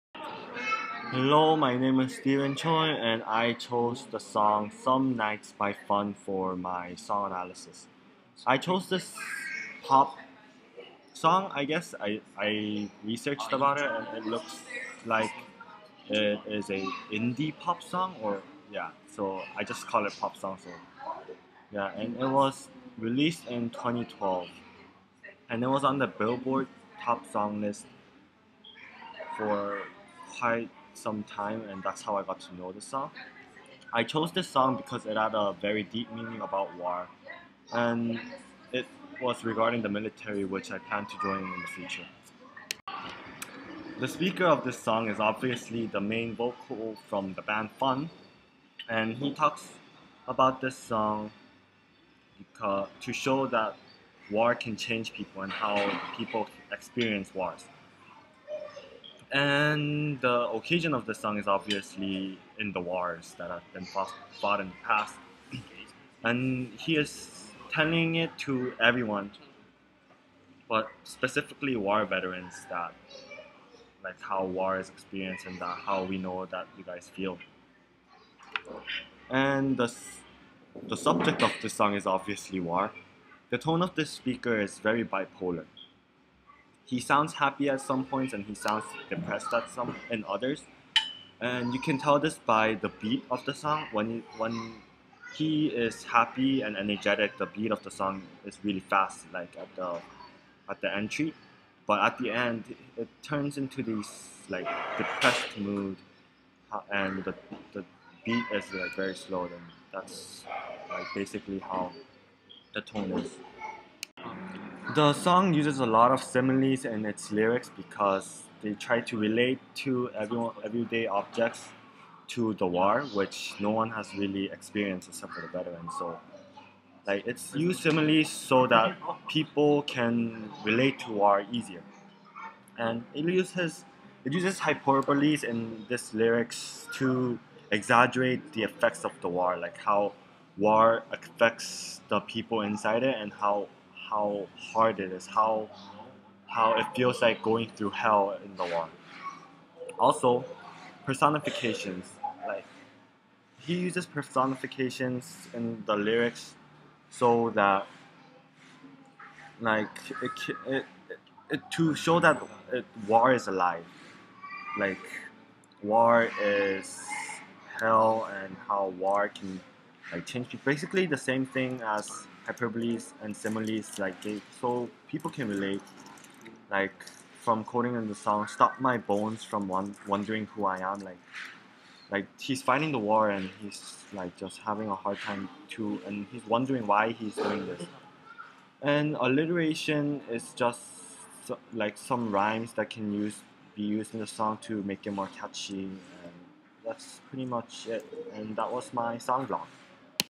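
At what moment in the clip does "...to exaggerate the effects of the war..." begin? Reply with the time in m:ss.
2:16.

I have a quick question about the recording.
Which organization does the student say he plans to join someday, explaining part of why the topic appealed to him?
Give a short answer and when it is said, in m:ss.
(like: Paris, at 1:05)
The military, at 0:39.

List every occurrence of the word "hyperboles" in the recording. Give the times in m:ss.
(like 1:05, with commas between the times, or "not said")
2:14, 2:52.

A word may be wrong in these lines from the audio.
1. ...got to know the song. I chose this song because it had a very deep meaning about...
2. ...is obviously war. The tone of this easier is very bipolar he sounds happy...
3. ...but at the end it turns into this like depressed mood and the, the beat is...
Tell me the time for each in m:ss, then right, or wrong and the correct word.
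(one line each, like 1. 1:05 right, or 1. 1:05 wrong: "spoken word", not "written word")
1. 0:32 right
2. 1:21 wrong: "speaker", not "easier"
3. 1:41 right.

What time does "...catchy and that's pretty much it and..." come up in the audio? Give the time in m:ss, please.
3:15.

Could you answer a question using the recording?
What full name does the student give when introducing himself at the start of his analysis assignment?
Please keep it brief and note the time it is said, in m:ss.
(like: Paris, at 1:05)
Steven Choi, at 0:02.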